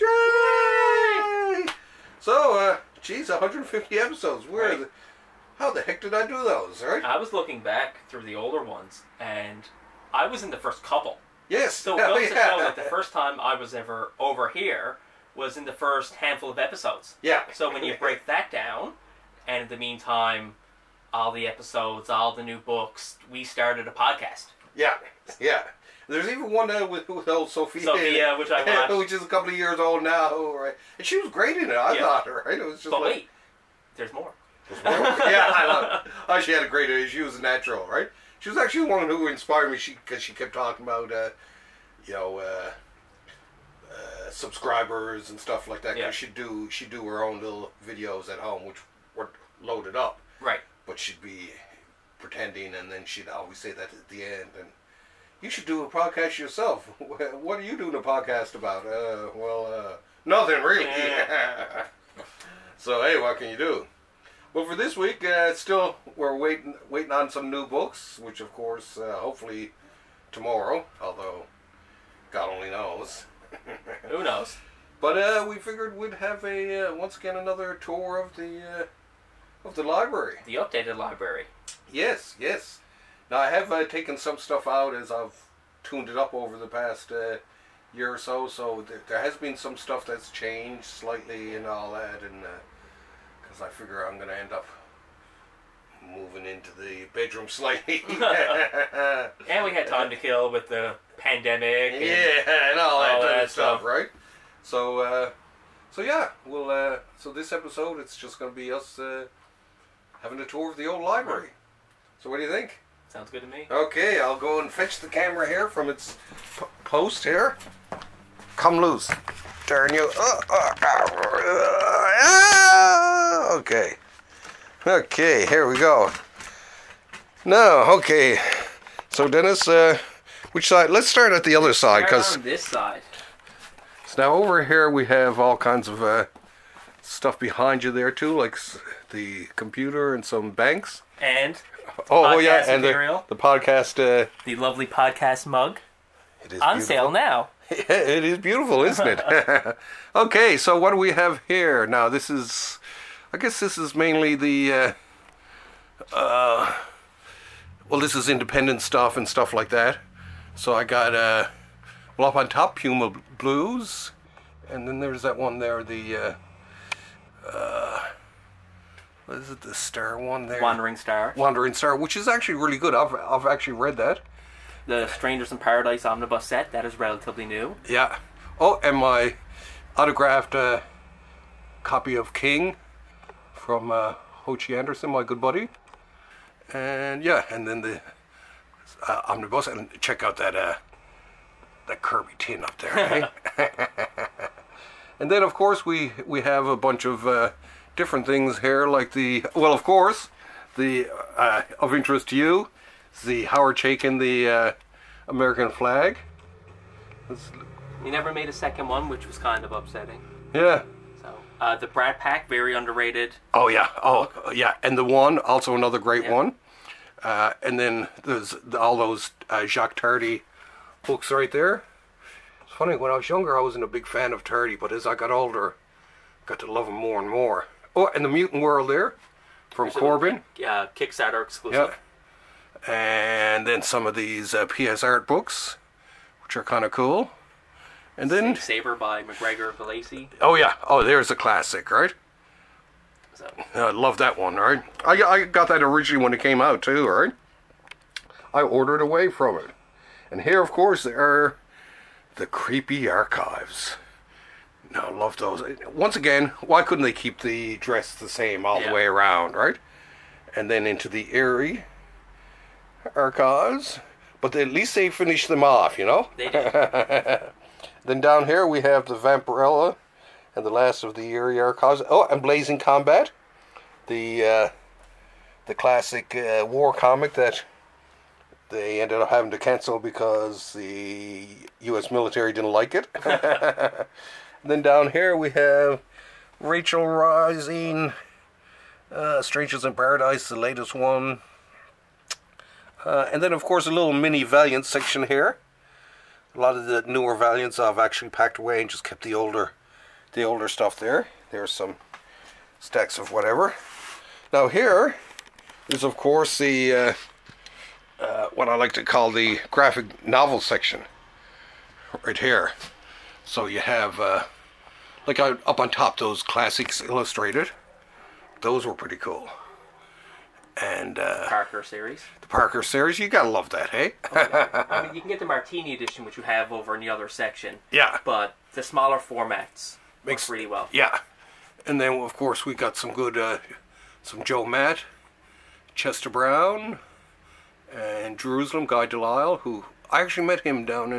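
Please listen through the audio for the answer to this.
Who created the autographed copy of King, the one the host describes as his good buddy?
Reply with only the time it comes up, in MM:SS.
03:04.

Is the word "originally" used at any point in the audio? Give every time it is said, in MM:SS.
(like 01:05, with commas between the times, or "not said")
04:05.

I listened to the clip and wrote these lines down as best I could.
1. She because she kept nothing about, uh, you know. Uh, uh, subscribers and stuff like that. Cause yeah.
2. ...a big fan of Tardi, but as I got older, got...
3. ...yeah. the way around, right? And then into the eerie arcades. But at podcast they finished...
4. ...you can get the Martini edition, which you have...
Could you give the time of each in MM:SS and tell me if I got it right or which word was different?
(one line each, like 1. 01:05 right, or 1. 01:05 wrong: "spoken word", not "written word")
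1. 00:39 wrong: "talking", not "nothing"
2. 03:43 right
3. 04:18 wrong: "least", not "podcast"
4. 05:25 right.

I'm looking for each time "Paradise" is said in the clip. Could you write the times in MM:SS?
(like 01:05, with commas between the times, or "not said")
02:55, 04:49.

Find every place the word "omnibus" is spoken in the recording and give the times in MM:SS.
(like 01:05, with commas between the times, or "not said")
02:56, 03:09.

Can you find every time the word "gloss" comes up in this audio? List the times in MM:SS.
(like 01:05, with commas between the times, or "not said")
not said.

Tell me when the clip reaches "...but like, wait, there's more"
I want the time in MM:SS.
00:32.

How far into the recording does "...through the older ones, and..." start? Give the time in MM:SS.
00:08.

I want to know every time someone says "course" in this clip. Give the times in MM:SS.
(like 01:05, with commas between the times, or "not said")
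01:08, 03:15, 03:19, 04:10, 04:53, 05:06, 05:32.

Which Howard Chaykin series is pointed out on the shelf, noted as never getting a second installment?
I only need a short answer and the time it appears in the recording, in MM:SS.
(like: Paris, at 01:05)
American Flag, at 03:25.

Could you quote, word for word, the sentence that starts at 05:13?
So you have uh, like I, up on top, those classics illustrated.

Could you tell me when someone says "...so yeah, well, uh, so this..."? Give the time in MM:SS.
01:45.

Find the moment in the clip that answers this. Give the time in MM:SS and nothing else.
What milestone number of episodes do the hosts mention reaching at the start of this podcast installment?
00:03.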